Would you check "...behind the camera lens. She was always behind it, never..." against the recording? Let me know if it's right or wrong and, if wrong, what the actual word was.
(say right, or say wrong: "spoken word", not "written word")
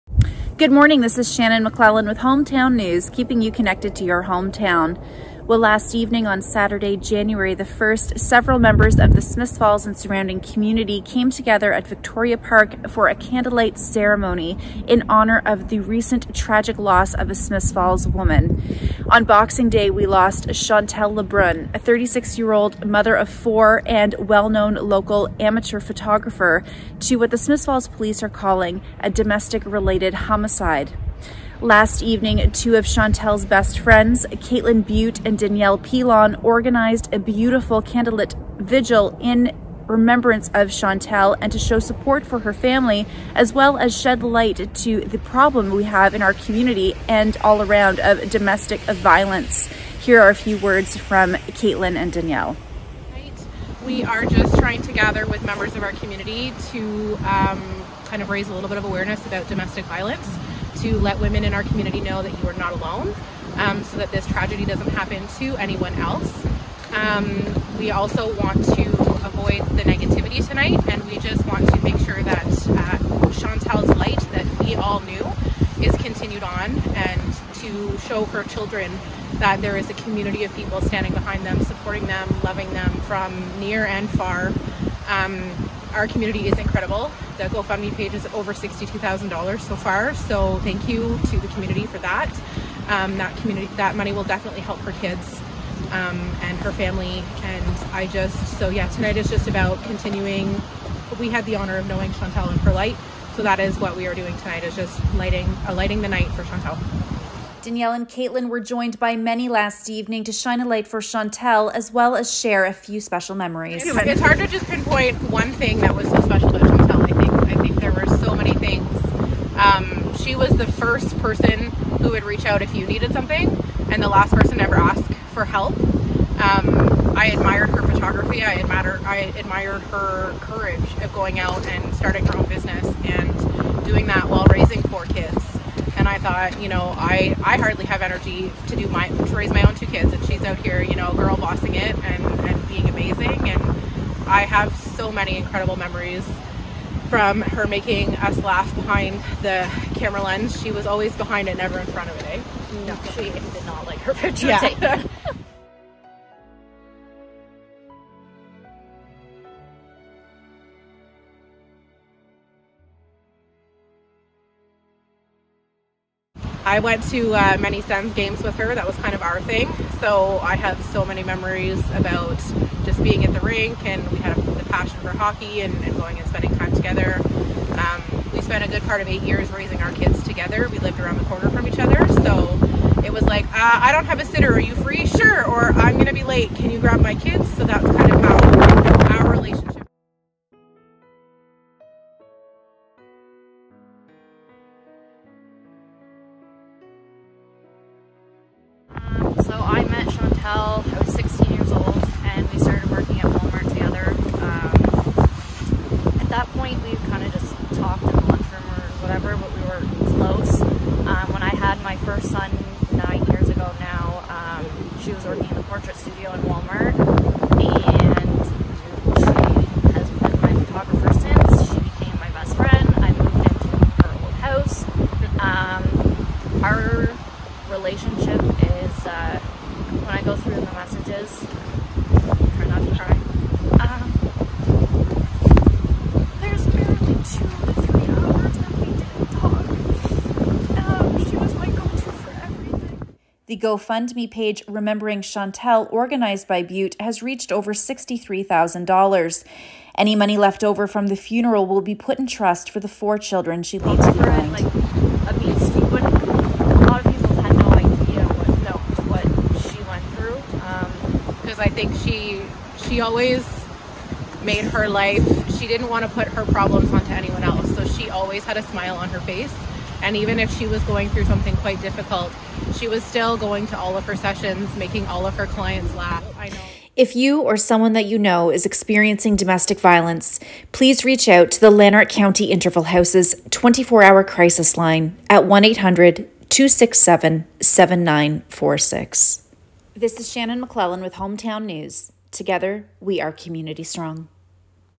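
right.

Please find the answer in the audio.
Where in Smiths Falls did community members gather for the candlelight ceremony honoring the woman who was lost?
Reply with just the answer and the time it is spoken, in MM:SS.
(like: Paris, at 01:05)
Victoria Park, at 00:11.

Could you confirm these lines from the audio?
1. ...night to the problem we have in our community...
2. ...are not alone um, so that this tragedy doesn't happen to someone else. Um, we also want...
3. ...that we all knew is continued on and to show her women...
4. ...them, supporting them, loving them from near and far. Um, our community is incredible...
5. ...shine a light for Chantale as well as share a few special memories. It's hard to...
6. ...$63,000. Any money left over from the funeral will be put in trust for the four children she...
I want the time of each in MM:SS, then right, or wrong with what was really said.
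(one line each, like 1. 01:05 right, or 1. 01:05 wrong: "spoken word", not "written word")
1. 00:44 wrong: "light", not "night"
2. 01:02 wrong: "anyone", not "someone"
3. 01:14 wrong: "children", not "women"
4. 01:21 right
5. 01:50 right
6. 04:07 right.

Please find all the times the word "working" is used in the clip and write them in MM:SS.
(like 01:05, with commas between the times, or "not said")
03:22, 03:35.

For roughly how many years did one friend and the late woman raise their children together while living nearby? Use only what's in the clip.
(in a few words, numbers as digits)
8.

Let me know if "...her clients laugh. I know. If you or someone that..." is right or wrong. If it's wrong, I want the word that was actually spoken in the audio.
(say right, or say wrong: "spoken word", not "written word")
right.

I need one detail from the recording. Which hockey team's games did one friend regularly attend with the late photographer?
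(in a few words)
Sens.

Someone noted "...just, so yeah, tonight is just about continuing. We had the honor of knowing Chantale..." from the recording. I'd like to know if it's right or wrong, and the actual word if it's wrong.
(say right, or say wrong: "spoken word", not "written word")
right.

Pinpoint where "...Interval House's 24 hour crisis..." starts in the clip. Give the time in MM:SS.
04:42.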